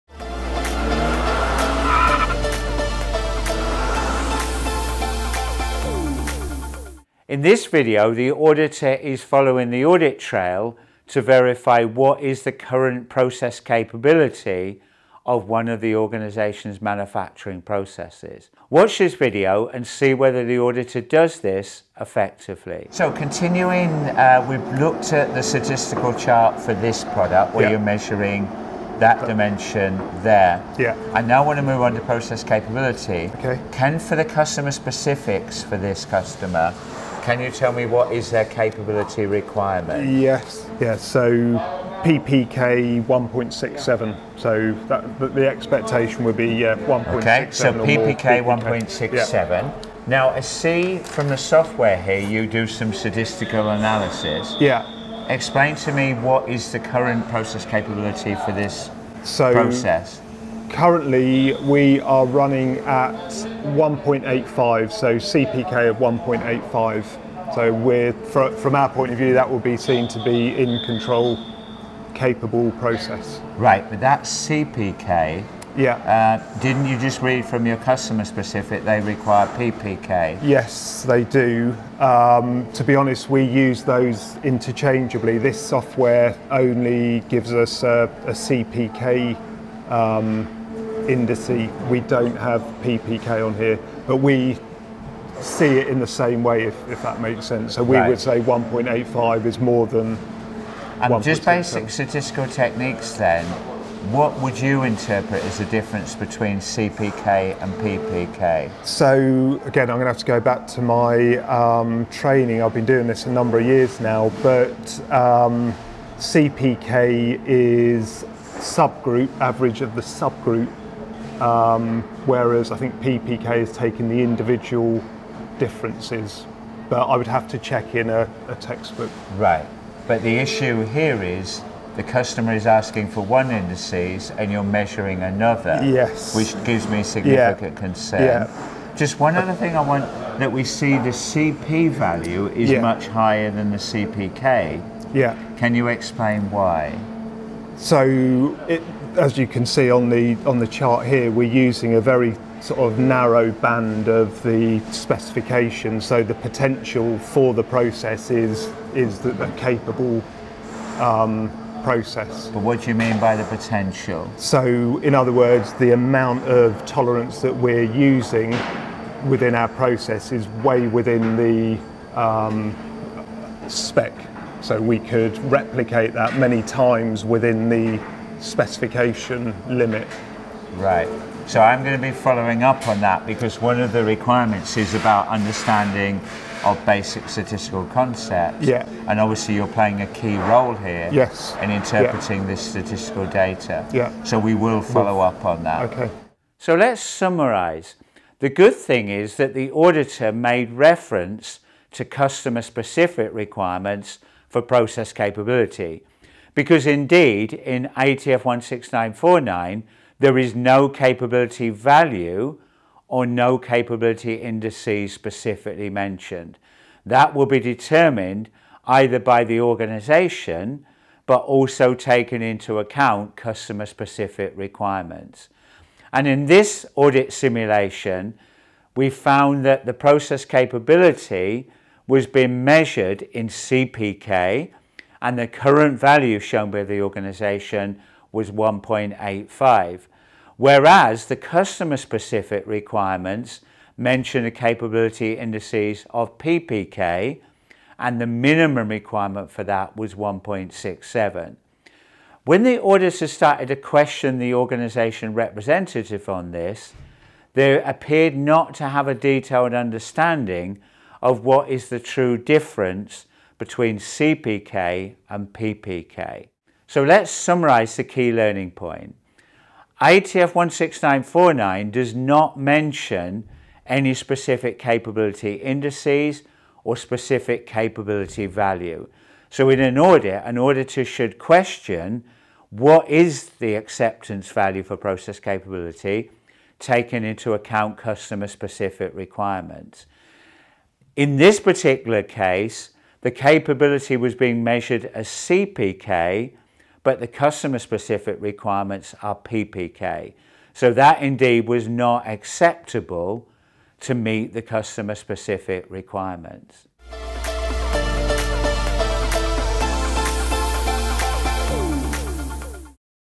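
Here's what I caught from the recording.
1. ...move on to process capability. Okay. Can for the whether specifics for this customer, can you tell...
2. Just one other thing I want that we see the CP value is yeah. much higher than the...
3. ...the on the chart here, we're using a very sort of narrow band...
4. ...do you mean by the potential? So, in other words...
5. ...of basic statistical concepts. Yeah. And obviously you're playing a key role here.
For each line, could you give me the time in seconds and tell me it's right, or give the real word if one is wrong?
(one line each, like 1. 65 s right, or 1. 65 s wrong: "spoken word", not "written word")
1. 31 s wrong: "customer", not "whether"
2. 138 s right
3. 150 s right
4. 162 s right
5. 186 s right.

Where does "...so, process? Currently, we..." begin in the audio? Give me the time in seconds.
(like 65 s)
59 s.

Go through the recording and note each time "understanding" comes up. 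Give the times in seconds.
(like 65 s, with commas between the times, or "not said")
185 s, 259 s.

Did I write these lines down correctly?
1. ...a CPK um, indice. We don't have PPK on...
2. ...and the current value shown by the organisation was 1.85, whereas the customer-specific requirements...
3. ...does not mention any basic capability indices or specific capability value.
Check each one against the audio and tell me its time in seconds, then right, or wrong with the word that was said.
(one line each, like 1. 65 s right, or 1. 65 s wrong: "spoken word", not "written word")
1. 88 s right
2. 235 s right
3. 271 s wrong: "specific", not "basic".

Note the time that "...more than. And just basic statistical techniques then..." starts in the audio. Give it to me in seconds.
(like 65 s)
99 s.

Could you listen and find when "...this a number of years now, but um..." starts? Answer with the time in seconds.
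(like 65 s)
113 s.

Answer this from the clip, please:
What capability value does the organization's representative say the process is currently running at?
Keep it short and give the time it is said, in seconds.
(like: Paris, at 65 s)
1.85, at 65 s.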